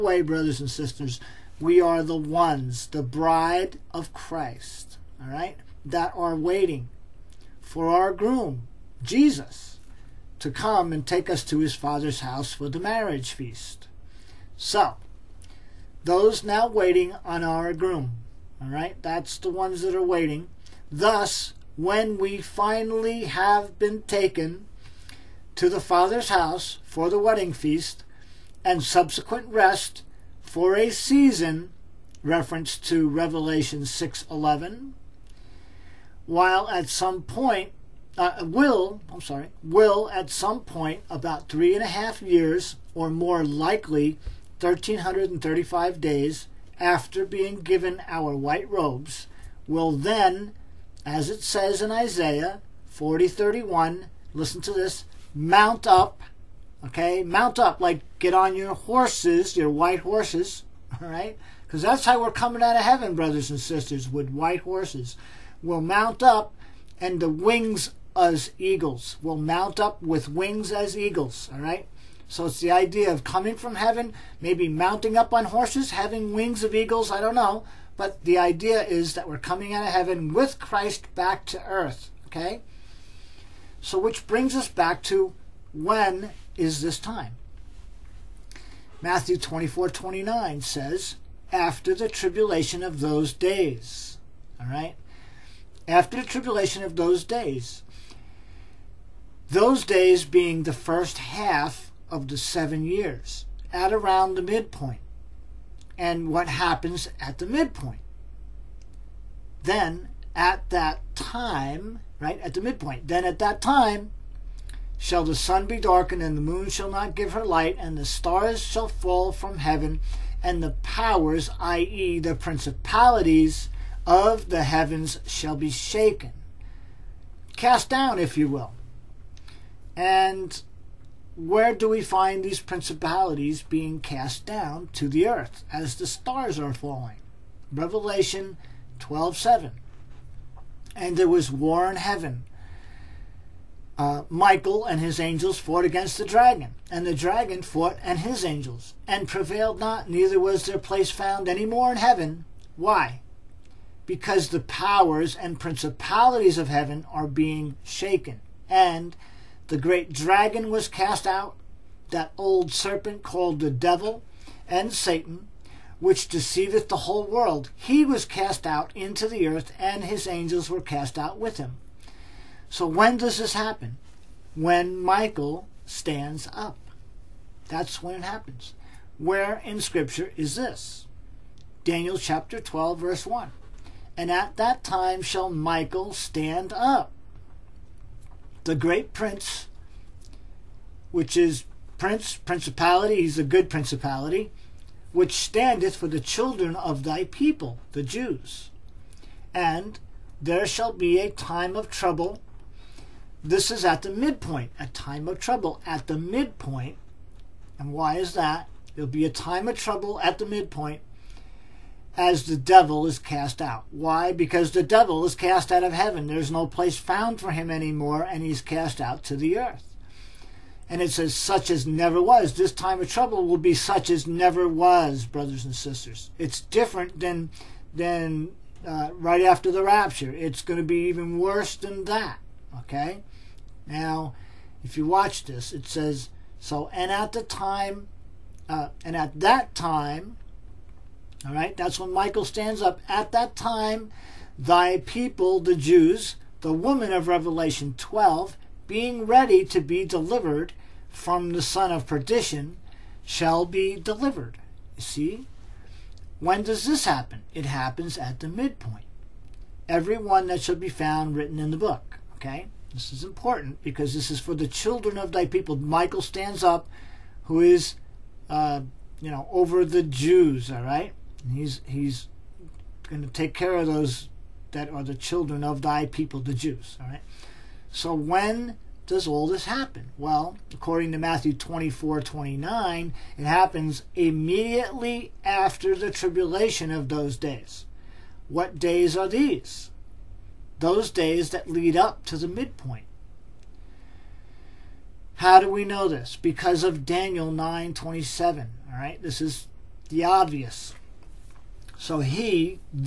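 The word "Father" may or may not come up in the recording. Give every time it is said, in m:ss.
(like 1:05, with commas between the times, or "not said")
0:11, 0:25.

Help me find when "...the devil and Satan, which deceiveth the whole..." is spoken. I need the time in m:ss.
2:43.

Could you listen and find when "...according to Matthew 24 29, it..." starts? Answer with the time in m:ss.
4:40.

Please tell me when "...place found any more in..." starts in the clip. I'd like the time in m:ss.
2:30.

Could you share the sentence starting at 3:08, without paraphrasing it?
The great prince, which is prince, principality, he's a good principality, which standeth for the children of thy people, the Jews.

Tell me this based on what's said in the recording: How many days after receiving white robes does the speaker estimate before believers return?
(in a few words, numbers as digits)
1335.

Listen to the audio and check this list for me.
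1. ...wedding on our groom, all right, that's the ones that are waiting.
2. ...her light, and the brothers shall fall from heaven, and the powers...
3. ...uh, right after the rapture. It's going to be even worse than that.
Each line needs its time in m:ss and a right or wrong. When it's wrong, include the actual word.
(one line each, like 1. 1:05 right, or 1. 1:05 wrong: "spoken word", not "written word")
1. 0:16 wrong: "waiting", not "wedding"
2. 1:57 wrong: "stars", not "brothers"
3. 3:48 right.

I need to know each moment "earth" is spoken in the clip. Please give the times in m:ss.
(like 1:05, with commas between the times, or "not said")
1:21, 2:15, 2:49, 3:39.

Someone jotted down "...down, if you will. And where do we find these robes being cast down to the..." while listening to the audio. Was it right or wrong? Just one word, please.
wrong.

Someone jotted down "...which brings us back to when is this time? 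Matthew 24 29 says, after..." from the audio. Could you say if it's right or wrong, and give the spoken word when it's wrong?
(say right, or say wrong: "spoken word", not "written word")
right.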